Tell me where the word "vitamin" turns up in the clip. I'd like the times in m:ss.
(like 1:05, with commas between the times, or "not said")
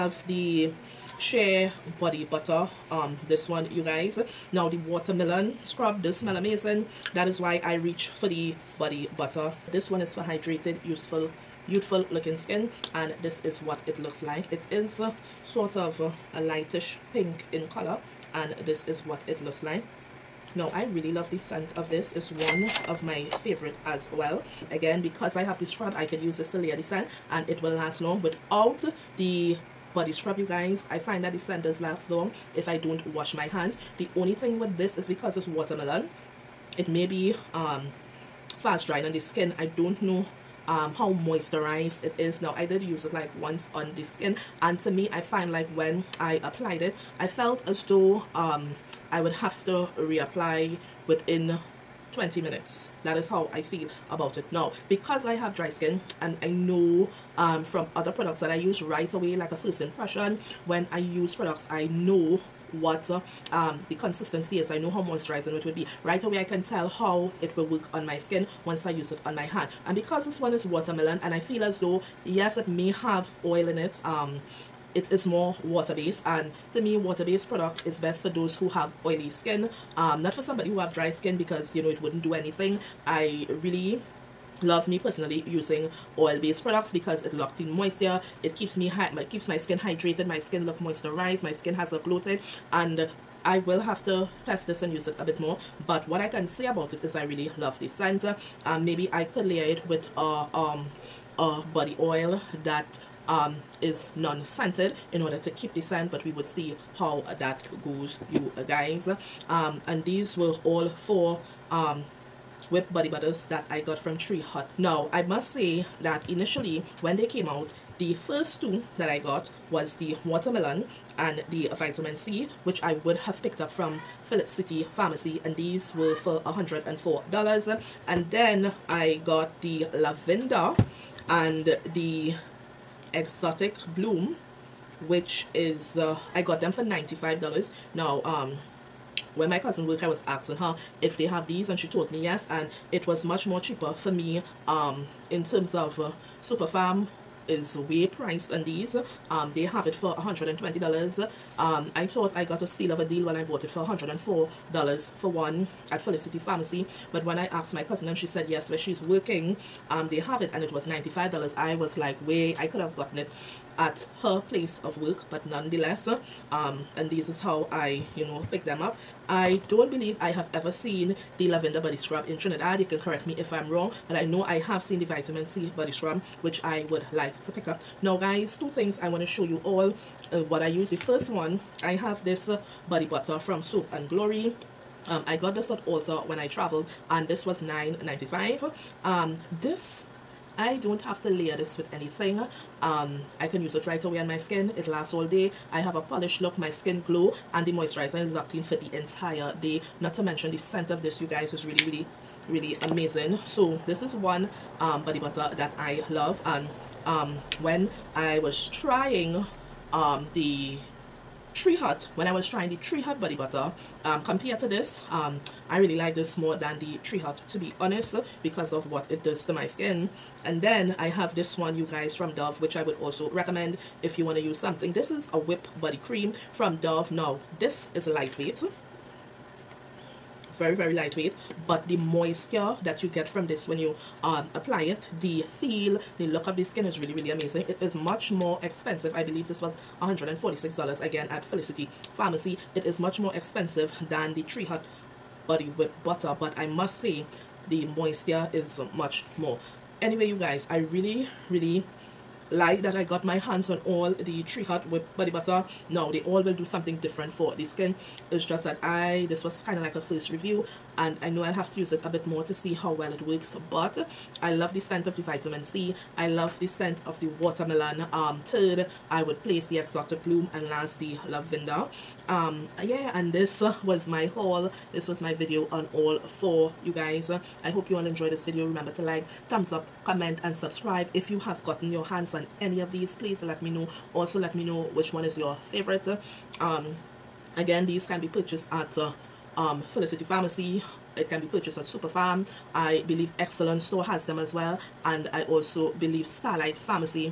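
2:01, 2:55, 4:25.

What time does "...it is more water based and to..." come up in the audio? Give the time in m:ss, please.
1:14.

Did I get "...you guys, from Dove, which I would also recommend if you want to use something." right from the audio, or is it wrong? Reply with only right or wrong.
right.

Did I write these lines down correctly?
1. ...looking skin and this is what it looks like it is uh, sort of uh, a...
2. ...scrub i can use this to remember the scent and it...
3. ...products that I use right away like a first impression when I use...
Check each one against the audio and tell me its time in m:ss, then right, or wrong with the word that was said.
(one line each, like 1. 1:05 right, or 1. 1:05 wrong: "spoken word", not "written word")
1. 0:12 right
2. 0:25 wrong: "layer", not "remember"
3. 0:58 right.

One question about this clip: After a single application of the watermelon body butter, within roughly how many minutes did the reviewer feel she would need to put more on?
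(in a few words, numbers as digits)
20 minutes.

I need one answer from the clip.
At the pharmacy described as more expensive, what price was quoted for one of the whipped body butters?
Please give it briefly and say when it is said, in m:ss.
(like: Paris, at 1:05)
$120, at 2:30.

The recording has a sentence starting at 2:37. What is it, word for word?
But when I asked my cousin and she said yes, where she's working, um, they have it and it was $95.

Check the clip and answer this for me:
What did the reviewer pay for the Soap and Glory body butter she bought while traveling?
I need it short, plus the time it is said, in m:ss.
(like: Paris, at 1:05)
9.95, at 3:07.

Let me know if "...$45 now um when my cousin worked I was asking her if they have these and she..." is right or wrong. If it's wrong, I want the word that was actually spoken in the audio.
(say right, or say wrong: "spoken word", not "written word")
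wrong: "95", not "45".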